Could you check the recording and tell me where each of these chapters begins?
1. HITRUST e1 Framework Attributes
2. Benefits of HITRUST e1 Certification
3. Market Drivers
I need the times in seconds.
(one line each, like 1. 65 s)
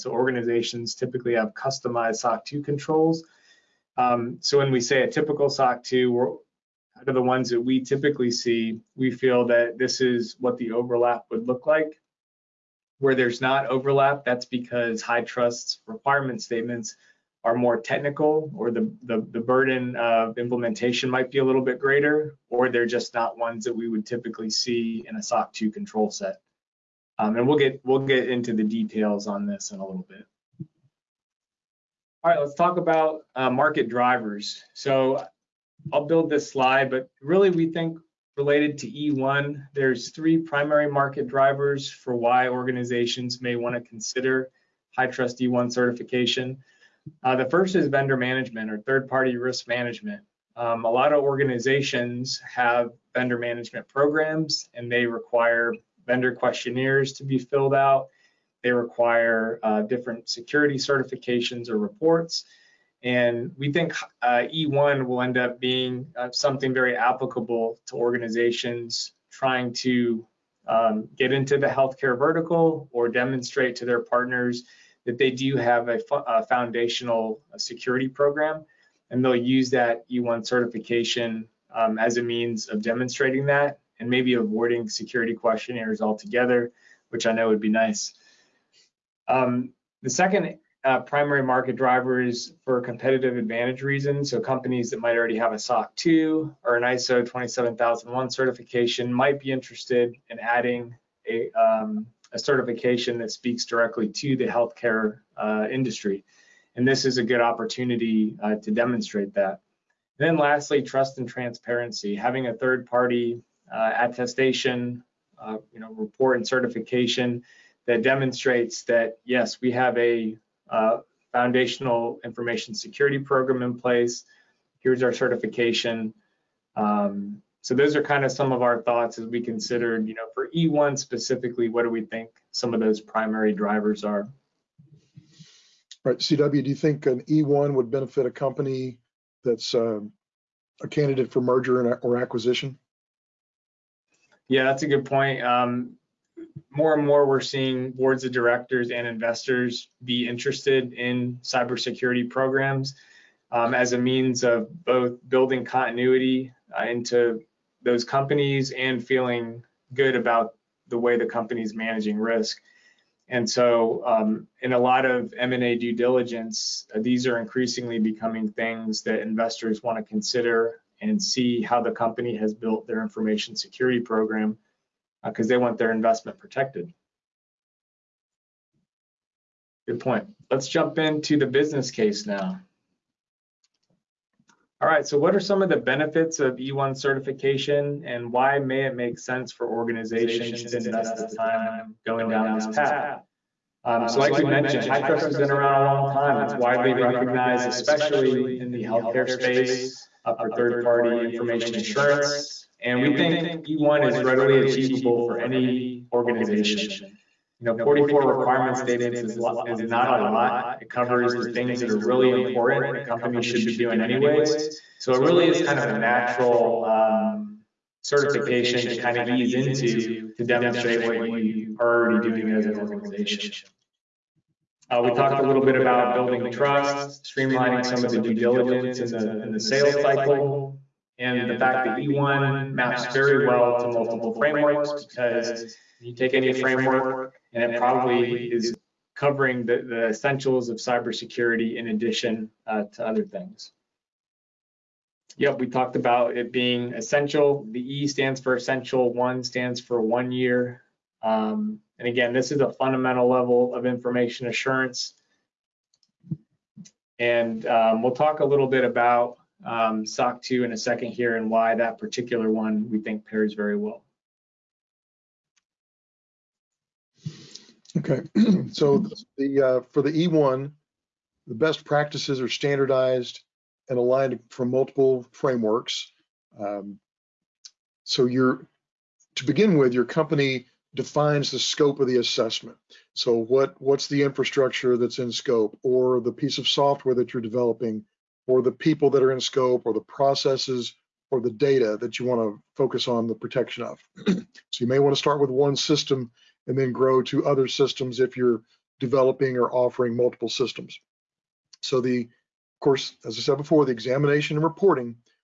1. 267 s
2. 184 s
3. 31 s.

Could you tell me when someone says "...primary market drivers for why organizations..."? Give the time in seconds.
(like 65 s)
40 s.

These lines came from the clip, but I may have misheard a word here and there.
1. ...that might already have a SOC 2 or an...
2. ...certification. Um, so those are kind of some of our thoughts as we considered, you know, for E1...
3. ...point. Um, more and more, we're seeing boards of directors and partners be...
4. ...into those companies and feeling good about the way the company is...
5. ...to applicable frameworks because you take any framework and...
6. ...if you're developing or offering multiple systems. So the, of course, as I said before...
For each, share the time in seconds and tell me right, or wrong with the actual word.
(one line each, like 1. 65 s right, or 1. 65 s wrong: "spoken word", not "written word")
1. 94 s right
2. 125 s right
3. 145 s wrong: "investors", not "partners"
4. 156 s right
5. 233 s wrong: "multiple", not "applicable"
6. 298 s right.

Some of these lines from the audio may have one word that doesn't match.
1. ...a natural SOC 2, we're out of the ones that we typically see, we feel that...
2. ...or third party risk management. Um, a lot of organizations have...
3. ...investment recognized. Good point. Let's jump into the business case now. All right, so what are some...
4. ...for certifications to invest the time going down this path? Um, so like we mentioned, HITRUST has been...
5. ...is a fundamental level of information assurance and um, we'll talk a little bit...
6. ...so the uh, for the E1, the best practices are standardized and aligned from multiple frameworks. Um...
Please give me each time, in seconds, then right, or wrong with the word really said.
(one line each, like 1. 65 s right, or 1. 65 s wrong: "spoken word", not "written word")
1. 5 s wrong: "typical", not "natural"
2. 48 s right
3. 175 s wrong: "protected", not "recognized"
4. 189 s wrong: "organizations", not "certifications"
5. 252 s right
6. 268 s right.